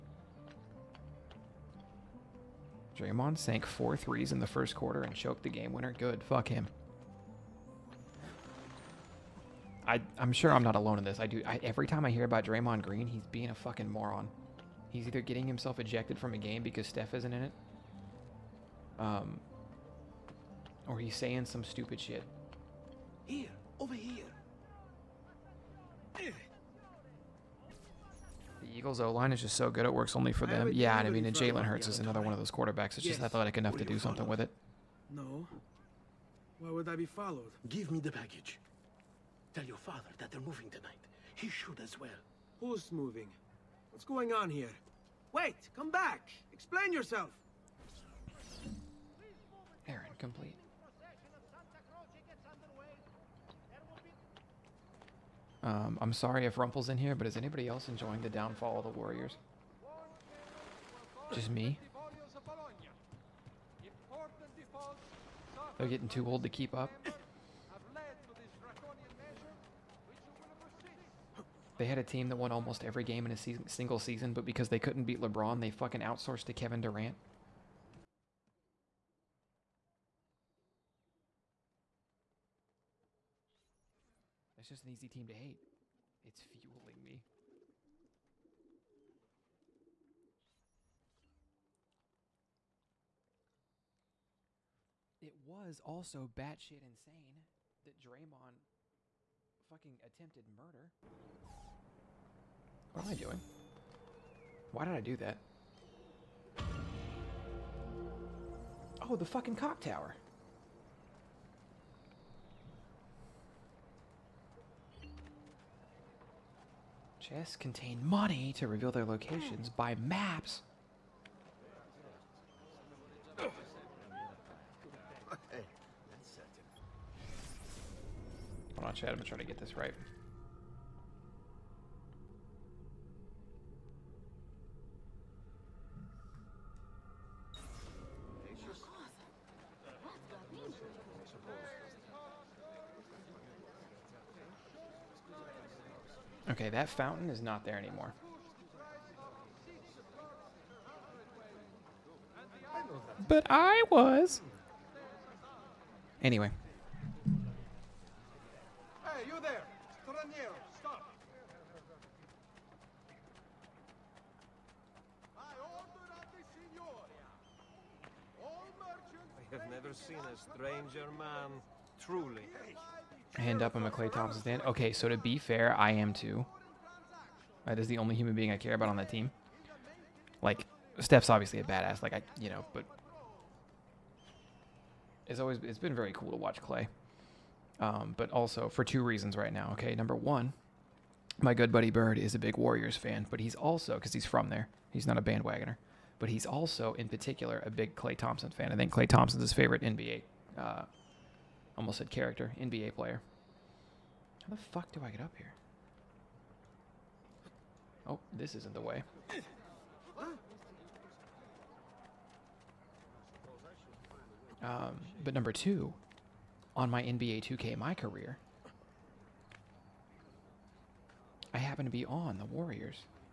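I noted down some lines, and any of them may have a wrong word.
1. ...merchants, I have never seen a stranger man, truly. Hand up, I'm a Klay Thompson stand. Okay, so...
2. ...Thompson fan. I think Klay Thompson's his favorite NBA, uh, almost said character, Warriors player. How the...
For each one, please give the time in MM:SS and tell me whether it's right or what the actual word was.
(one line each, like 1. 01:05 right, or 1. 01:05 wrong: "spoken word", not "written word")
1. 02:48 right
2. 03:18 wrong: "NBA", not "Warriors".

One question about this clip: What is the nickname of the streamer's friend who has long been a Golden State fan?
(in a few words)
Bird.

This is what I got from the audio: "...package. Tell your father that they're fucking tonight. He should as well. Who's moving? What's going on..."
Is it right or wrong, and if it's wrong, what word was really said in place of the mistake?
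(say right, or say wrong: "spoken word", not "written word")
wrong: "moving", not "fucking".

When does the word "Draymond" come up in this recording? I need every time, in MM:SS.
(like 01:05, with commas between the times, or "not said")
00:02, 00:12, 01:37.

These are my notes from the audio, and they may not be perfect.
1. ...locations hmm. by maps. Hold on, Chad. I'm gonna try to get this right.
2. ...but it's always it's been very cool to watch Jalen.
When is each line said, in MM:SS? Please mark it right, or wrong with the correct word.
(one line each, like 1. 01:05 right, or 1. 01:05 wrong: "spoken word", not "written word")
1. 01:59 right
2. 03:02 wrong: "Klay", not "Jalen".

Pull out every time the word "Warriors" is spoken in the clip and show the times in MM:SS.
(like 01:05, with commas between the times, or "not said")
00:58, 03:12, 03:42.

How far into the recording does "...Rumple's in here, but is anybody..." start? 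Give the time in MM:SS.
00:56.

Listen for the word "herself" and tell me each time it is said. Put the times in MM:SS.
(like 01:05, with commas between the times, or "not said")
not said.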